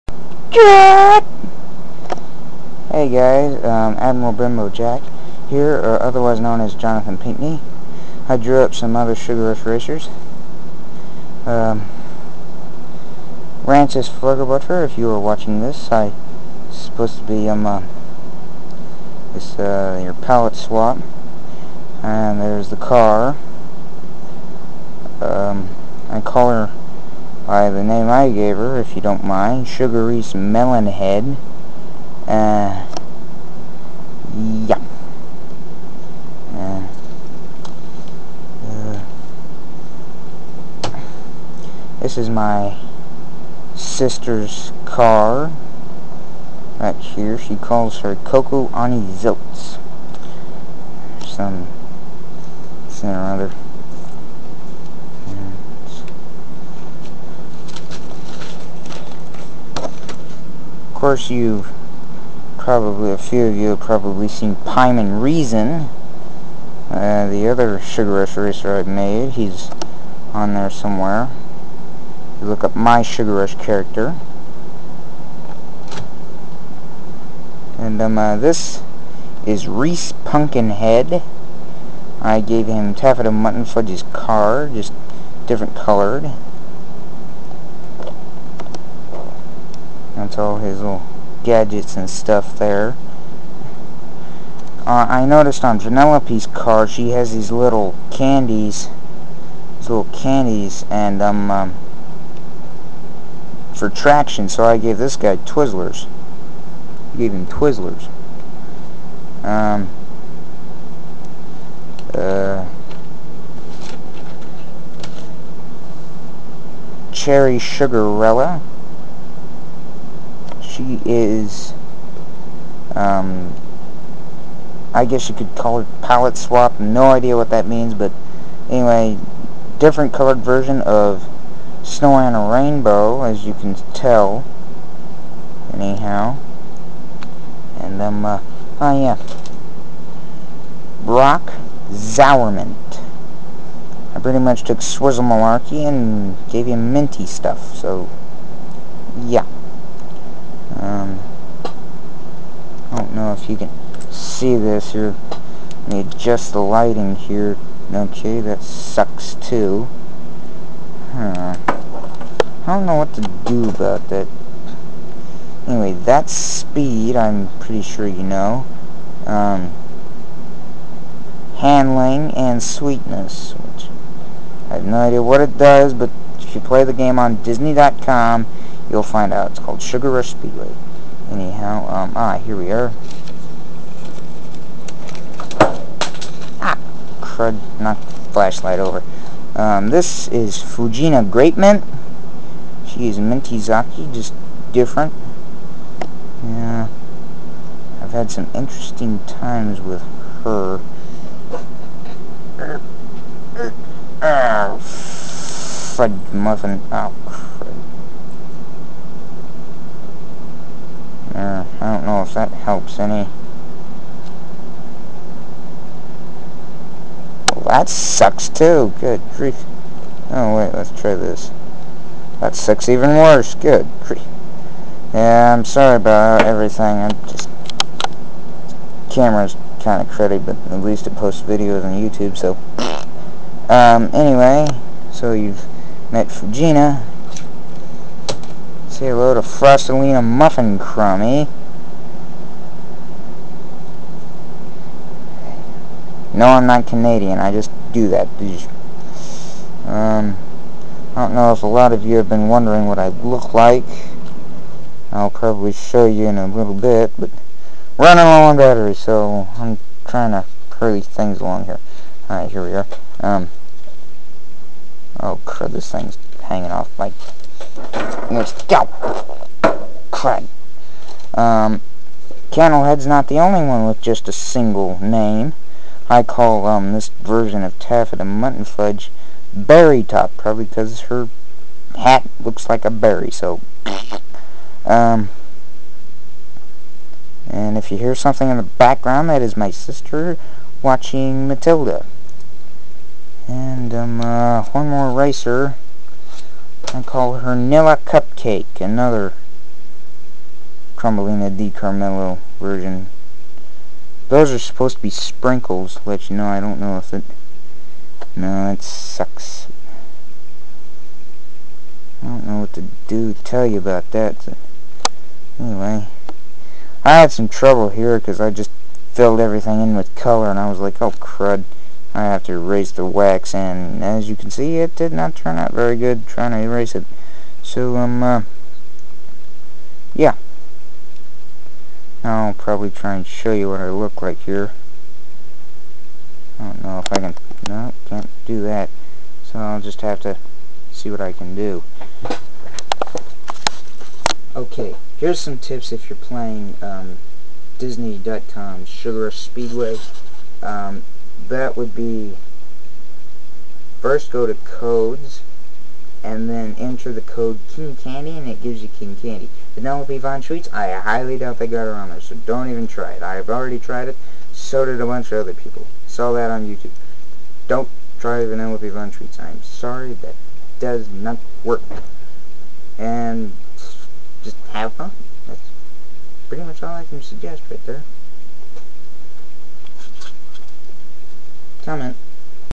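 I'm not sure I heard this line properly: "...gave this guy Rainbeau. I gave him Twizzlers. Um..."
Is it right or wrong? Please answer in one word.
wrong.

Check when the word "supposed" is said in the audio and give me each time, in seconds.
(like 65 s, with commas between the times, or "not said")
16 s, 304 s.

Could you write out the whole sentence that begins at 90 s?
That's all his little gadgets and stuff there.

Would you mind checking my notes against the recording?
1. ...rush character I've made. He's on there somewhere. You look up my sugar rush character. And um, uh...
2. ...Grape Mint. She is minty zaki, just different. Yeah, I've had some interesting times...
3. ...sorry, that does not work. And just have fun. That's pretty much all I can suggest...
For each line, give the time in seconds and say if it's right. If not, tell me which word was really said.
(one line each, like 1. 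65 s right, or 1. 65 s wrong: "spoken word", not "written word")
1. 68 s wrong: "racer", not "character"
2. 191 s right
3. 369 s right.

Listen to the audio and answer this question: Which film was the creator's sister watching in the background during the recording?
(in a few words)
Matilda.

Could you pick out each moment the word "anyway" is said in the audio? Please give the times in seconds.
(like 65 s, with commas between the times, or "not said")
128 s, 165 s, 234 s, 315 s.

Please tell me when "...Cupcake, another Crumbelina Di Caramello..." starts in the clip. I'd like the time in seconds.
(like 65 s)
298 s.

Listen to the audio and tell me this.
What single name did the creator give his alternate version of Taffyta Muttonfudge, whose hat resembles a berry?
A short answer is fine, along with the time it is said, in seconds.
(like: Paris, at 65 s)
Berry Top, at 279 s.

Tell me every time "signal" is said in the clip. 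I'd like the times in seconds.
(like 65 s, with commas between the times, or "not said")
not said.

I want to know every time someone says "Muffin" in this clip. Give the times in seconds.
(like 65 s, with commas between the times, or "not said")
206 s, 240 s.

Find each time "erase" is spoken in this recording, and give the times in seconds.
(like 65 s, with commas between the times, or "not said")
322 s, 326 s.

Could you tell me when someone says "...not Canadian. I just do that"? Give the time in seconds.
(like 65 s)
246 s.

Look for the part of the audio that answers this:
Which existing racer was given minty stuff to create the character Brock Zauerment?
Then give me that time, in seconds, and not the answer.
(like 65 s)
144 s.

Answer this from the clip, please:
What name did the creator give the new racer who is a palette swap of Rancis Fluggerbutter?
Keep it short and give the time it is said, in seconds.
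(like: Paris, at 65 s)
Sugary's Melon Head, at 29 s.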